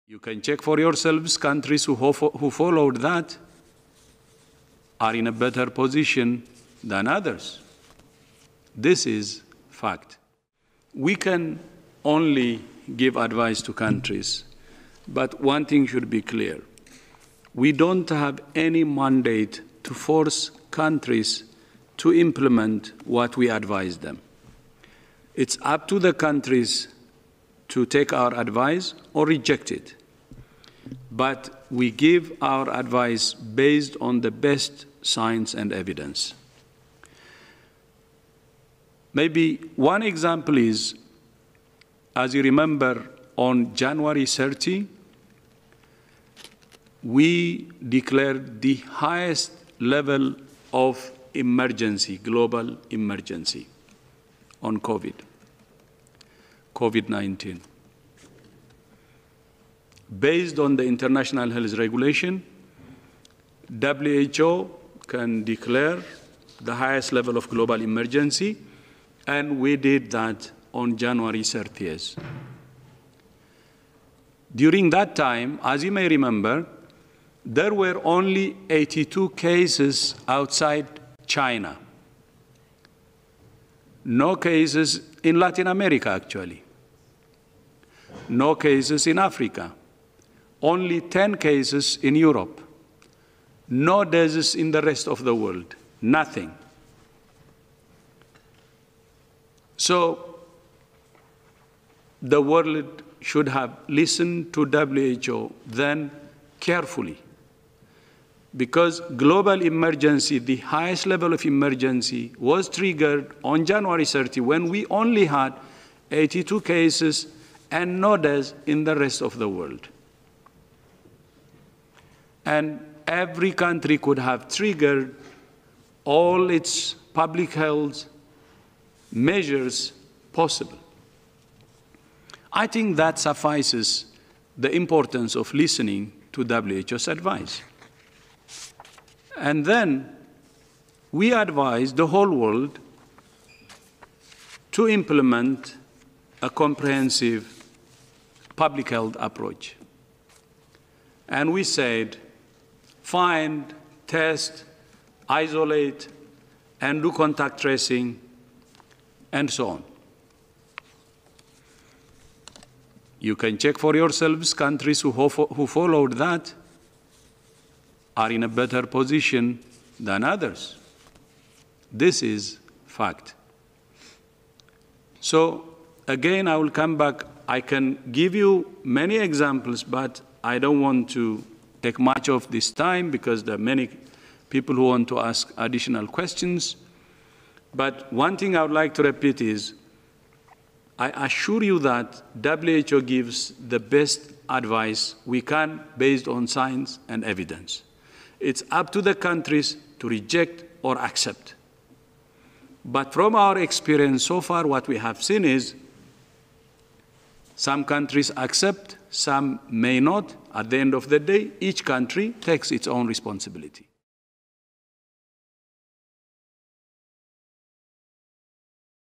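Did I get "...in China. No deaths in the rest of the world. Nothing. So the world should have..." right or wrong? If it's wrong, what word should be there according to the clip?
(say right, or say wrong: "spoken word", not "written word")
wrong: "Europe", not "China".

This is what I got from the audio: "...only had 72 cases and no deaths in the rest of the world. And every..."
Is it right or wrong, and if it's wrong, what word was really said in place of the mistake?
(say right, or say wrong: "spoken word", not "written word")
wrong: "82", not "72".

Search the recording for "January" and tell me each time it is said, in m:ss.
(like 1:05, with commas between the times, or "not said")
0:43, 1:10, 1:53.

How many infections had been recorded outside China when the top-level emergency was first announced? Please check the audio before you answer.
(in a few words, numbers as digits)
82.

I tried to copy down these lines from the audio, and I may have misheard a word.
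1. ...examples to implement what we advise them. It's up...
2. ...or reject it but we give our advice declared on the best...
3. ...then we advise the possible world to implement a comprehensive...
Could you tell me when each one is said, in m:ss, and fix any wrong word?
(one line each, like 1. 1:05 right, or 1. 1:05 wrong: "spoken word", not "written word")
1. 0:20 wrong: "countries", not "examples"
2. 0:29 wrong: "based", not "declared"
3. 2:19 wrong: "whole", not "possible".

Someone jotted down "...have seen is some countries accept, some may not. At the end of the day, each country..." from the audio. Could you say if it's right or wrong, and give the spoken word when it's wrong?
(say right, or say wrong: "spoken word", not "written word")
right.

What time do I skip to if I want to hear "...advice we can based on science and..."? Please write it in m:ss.
3:14.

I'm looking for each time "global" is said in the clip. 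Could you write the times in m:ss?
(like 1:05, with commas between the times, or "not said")
0:52, 1:07, 1:49.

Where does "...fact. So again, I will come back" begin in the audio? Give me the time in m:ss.
2:52.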